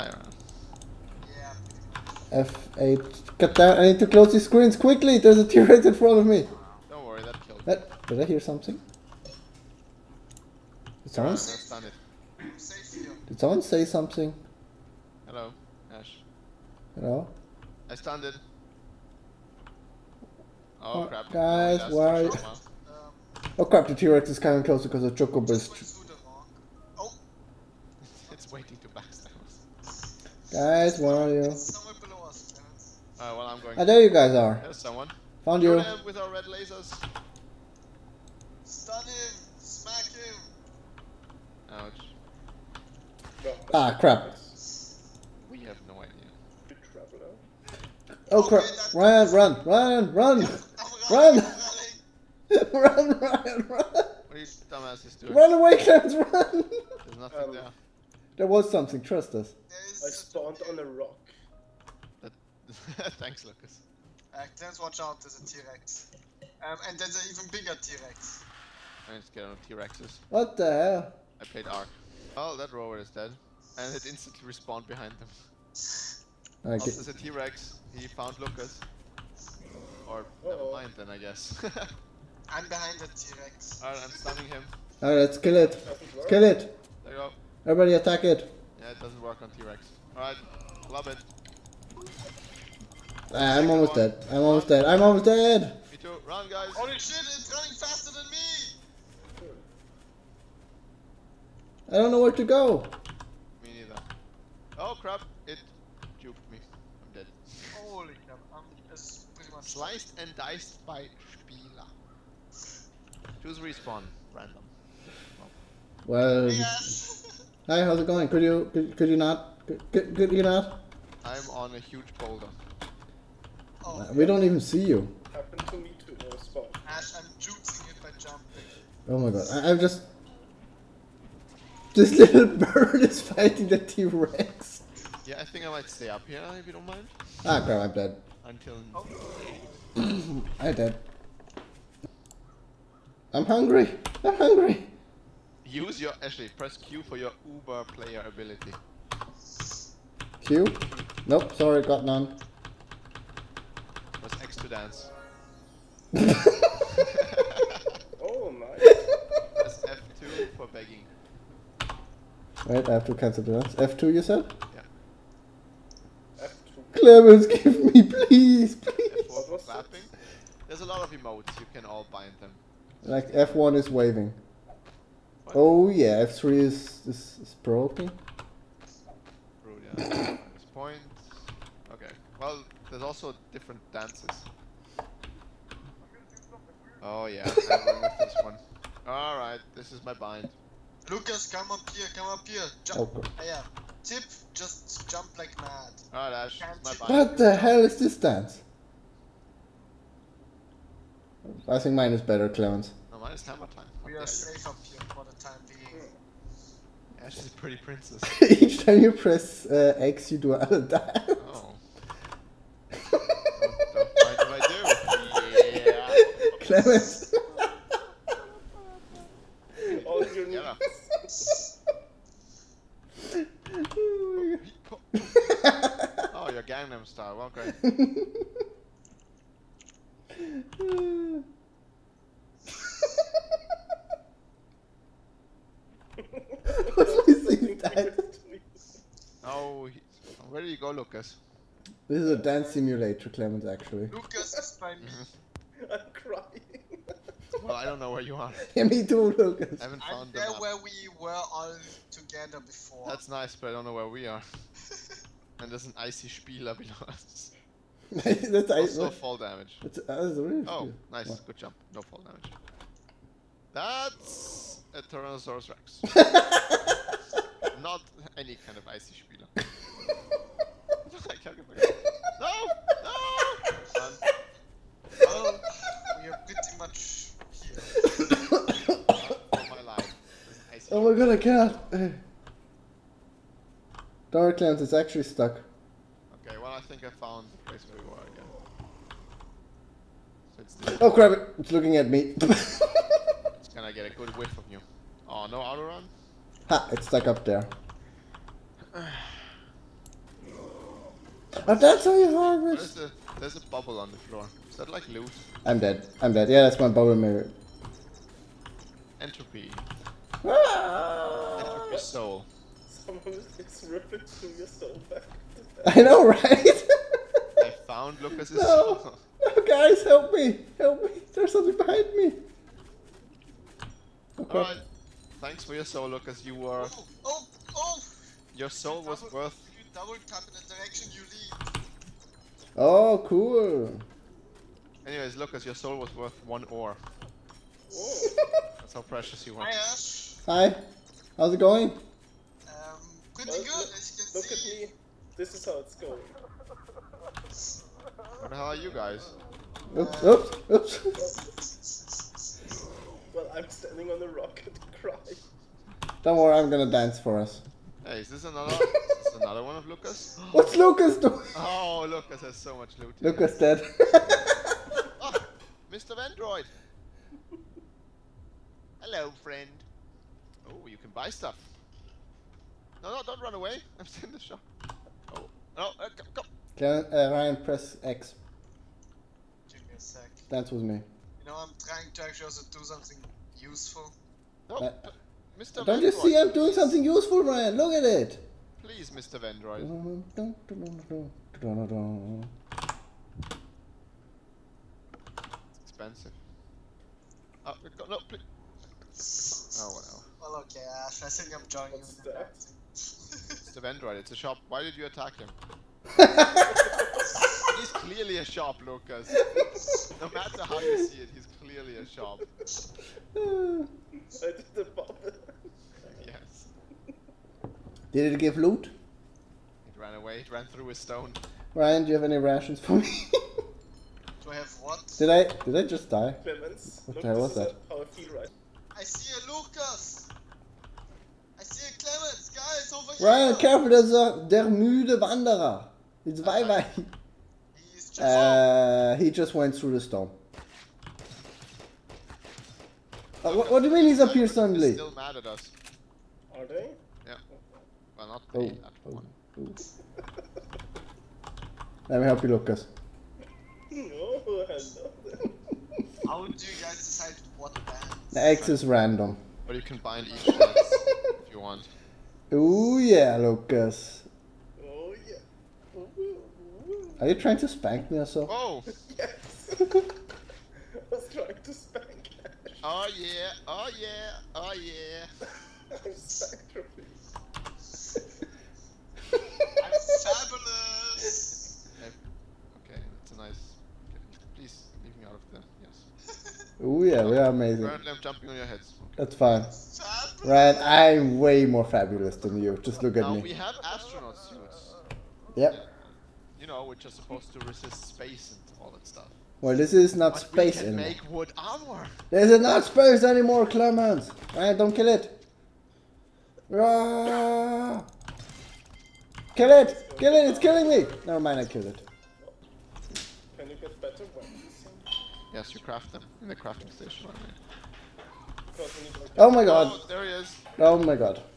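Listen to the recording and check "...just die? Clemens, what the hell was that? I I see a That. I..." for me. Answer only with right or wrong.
wrong.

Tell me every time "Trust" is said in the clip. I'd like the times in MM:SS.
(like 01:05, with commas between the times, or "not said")
00:59.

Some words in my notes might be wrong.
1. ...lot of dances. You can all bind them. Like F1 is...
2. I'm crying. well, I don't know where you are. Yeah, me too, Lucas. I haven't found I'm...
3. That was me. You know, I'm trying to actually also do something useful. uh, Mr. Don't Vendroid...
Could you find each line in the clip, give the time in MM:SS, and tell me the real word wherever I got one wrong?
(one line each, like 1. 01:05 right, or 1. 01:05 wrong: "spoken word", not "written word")
1. 02:50 wrong: "emotes", not "dances"
2. 04:05 right
3. 06:20 right.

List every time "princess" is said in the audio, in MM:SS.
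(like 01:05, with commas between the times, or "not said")
03:27.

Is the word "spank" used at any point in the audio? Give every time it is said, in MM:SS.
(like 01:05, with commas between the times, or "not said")
07:47, 07:51.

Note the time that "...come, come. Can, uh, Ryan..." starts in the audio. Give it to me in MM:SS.
06:16.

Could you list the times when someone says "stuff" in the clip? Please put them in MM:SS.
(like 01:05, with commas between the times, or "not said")
06:11, 08:19.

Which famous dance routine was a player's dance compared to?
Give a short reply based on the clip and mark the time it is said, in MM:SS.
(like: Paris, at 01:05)
Hammer time, at 03:23.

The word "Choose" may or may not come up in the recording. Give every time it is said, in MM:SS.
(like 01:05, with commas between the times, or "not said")
01:53.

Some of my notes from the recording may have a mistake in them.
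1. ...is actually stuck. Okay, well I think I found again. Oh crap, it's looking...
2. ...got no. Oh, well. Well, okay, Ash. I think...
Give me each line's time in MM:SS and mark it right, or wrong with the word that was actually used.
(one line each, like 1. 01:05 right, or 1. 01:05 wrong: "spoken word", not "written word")
1. 04:44 right
2. 06:37 right.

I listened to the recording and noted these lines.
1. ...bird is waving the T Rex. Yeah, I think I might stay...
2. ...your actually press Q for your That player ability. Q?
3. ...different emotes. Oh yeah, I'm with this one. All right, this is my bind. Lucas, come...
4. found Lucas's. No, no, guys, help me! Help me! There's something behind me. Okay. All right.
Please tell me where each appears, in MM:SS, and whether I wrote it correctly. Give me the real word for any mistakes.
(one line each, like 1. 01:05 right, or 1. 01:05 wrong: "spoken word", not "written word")
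1. 02:12 wrong: "fighting", not "waving"
2. 02:26 wrong: "Uber", not "That"
3. 03:03 wrong: "dances", not "emotes"
4. 05:17 right.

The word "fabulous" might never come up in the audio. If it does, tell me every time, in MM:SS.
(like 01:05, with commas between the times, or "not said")
08:00, 08:11.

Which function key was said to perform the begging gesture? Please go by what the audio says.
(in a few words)
F2.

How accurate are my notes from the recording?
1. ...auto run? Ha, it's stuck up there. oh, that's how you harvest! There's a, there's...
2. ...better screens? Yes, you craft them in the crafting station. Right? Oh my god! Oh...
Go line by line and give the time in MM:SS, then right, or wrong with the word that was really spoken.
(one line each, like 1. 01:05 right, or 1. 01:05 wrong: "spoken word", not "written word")
1. 04:55 right
2. 08:33 wrong: "weapons", not "screens".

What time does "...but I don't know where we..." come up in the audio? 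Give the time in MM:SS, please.
04:13.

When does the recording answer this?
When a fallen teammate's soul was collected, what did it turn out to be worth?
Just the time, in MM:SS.
05:36.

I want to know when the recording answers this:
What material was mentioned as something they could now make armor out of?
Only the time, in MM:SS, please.
08:21.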